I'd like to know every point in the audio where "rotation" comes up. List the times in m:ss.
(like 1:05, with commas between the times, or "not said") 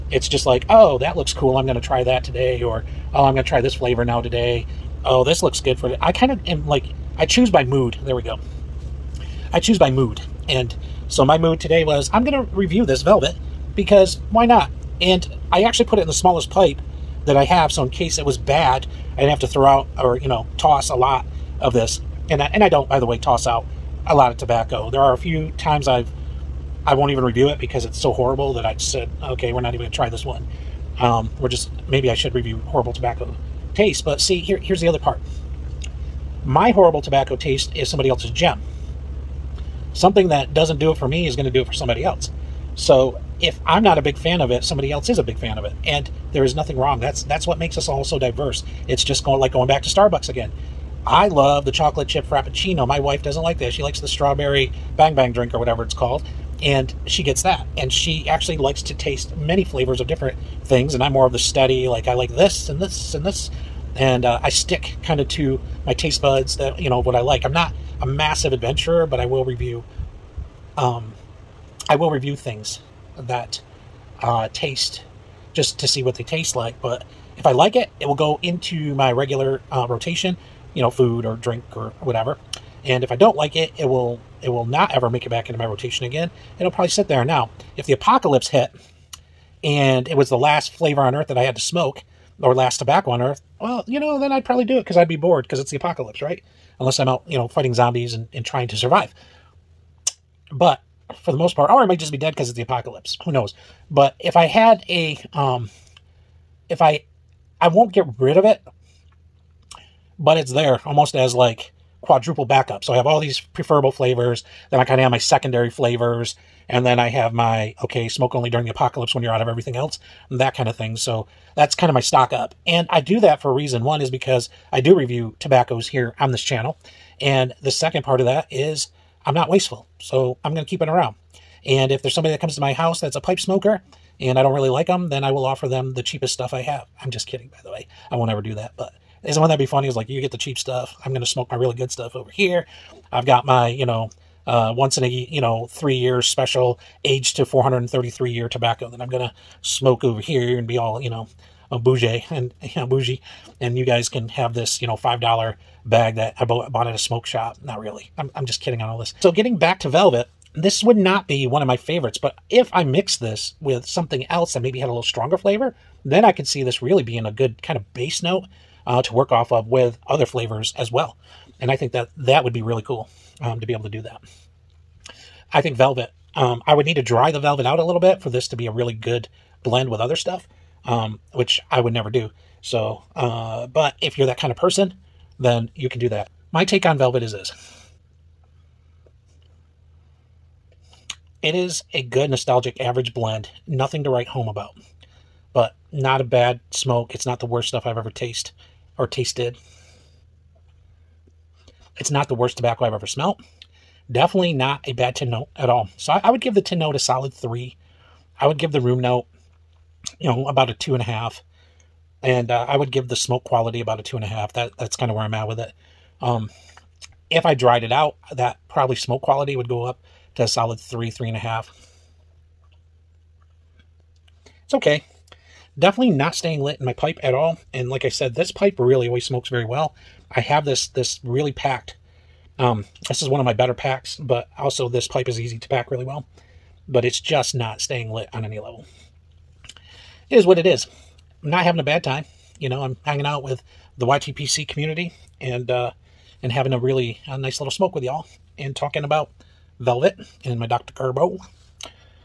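1:19, 1:25.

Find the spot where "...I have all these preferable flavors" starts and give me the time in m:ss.
1:52.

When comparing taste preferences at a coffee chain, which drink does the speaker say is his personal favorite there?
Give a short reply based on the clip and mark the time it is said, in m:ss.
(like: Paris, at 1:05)
chocolate chip frappuccino, at 0:51.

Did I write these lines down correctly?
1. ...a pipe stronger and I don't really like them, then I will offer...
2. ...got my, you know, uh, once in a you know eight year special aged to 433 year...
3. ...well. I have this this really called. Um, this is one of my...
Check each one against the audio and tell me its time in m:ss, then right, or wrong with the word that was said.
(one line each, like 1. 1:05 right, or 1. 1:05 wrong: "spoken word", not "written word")
1. 2:13 wrong: "smoker", not "stronger"
2. 2:23 wrong: "three", not "eight"
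3. 3:49 wrong: "packed", not "called".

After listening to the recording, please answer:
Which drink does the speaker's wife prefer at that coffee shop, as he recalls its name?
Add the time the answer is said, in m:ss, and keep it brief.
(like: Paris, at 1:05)
strawberry bang bang drink, at 0:54.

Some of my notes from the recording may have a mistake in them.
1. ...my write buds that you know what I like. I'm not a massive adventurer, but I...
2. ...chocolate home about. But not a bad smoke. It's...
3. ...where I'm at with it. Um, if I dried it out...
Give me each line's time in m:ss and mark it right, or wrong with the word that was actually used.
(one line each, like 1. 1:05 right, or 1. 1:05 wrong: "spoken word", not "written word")
1. 1:05 wrong: "taste", not "write"
2. 3:14 wrong: "write", not "chocolate"
3. 3:35 right.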